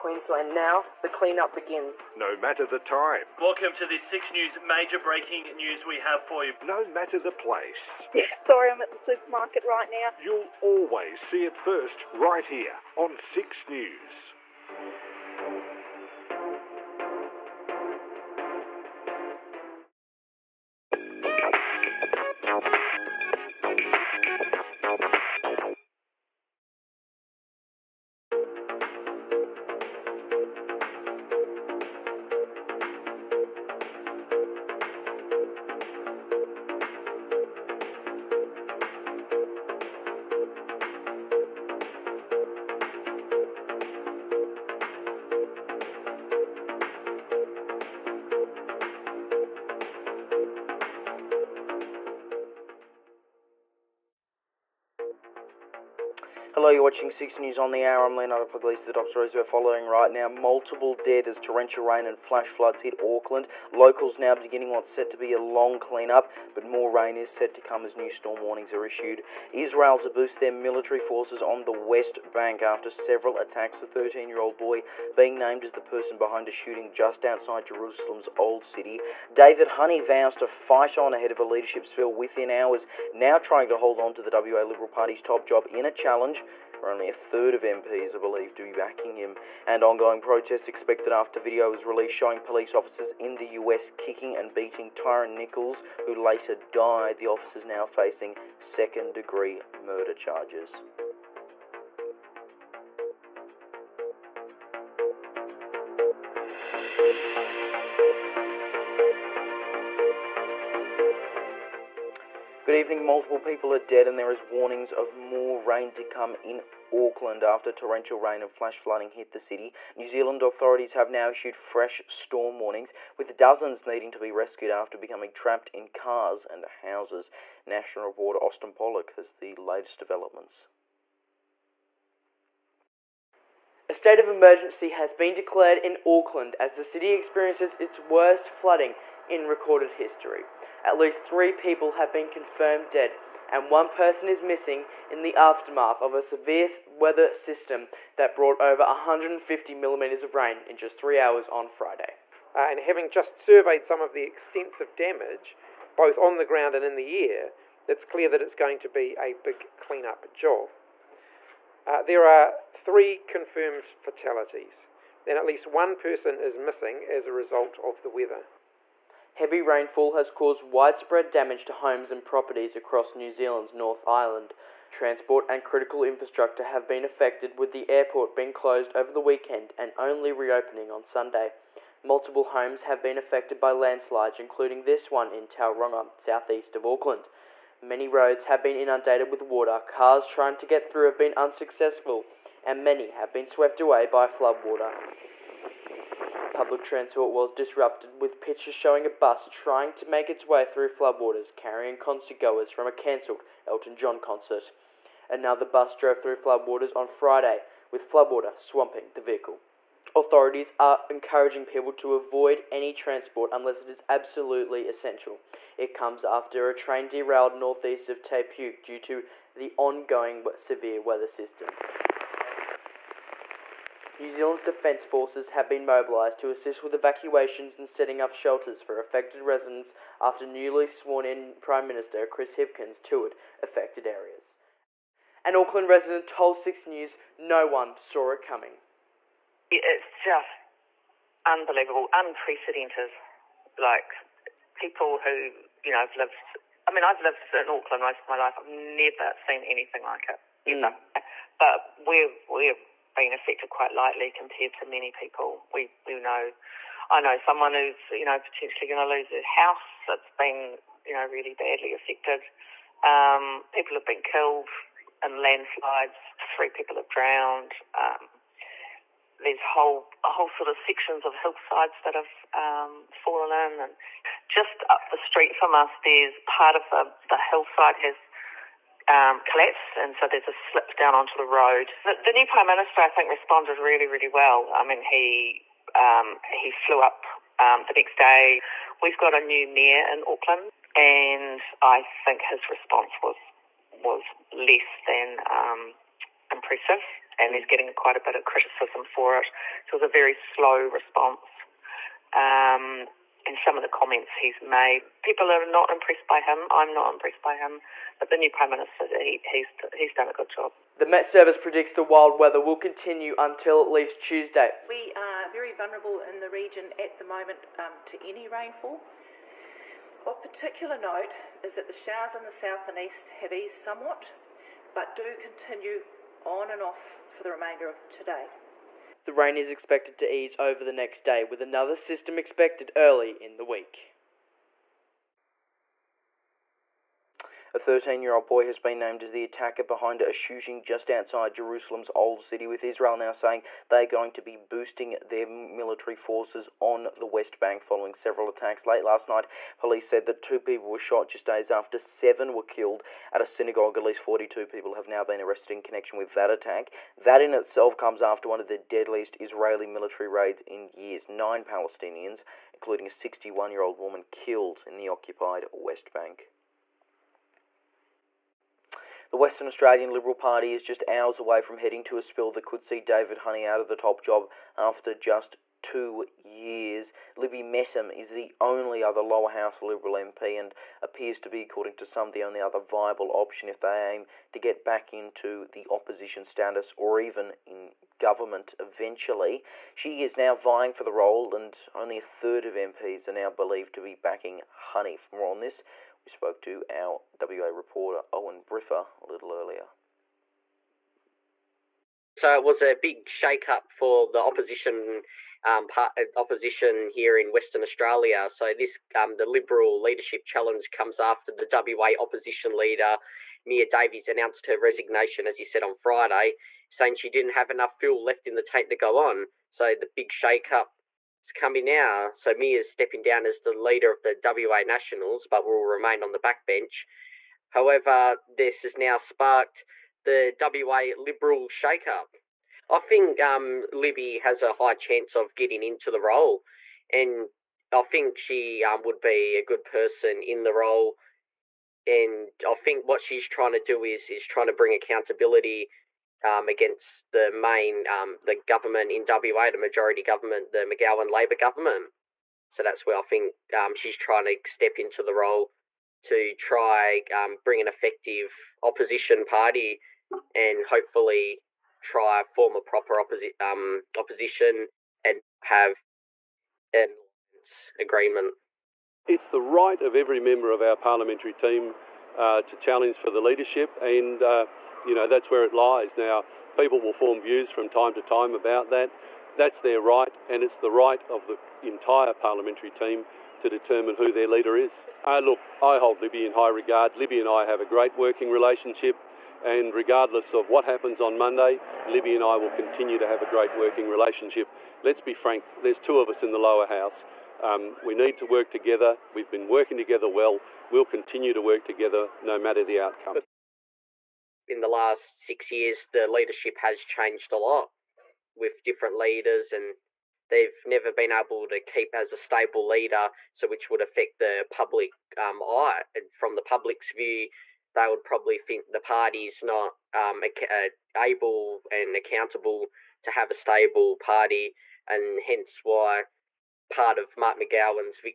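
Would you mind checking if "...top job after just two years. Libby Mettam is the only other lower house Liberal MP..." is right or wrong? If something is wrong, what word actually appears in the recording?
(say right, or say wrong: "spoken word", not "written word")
right.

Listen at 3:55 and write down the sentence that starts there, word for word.
An Auckland resident told 6 News no one saw it coming.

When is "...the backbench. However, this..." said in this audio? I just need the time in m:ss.
7:06.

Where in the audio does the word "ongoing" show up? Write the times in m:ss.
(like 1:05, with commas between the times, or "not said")
1:29, 3:39.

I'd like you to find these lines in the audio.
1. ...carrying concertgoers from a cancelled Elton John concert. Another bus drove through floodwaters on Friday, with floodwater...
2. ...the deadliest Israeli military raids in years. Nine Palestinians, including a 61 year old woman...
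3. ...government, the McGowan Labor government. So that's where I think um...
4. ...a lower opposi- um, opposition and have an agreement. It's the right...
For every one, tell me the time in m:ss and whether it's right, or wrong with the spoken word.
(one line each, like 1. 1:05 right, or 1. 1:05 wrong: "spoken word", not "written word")
1. 3:21 right
2. 5:58 right
3. 7:30 right
4. 7:42 wrong: "proper", not "lower".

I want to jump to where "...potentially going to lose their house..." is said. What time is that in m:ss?
4:18.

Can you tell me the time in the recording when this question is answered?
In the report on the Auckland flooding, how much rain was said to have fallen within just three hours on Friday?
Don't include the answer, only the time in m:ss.
2:28.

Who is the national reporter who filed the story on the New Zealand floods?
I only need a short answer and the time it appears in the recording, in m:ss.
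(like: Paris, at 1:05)
Austin Pollock, at 2:08.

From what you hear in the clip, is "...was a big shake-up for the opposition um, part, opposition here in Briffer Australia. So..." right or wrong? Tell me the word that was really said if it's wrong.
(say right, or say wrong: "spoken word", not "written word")
wrong: "Western", not "Briffer".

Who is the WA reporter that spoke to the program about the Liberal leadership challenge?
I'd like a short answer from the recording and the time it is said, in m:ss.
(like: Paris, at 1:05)
Owen Briffer, at 6:38.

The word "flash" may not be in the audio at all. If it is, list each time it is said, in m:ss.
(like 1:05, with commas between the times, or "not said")
1:02, 1:58.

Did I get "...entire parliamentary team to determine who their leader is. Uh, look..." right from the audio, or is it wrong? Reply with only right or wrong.
right.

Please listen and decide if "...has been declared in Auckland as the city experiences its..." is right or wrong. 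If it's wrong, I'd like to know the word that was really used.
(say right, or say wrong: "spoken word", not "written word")
right.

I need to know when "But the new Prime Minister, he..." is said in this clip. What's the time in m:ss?
5:08.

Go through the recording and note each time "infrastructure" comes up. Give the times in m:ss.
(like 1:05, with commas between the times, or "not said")
2:56.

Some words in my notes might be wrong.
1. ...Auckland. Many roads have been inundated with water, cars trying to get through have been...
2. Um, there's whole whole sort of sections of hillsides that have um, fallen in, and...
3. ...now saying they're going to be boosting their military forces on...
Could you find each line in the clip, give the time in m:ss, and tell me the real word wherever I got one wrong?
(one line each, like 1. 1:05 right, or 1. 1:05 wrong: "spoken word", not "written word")
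1. 3:06 right
2. 4:27 right
3. 5:43 right.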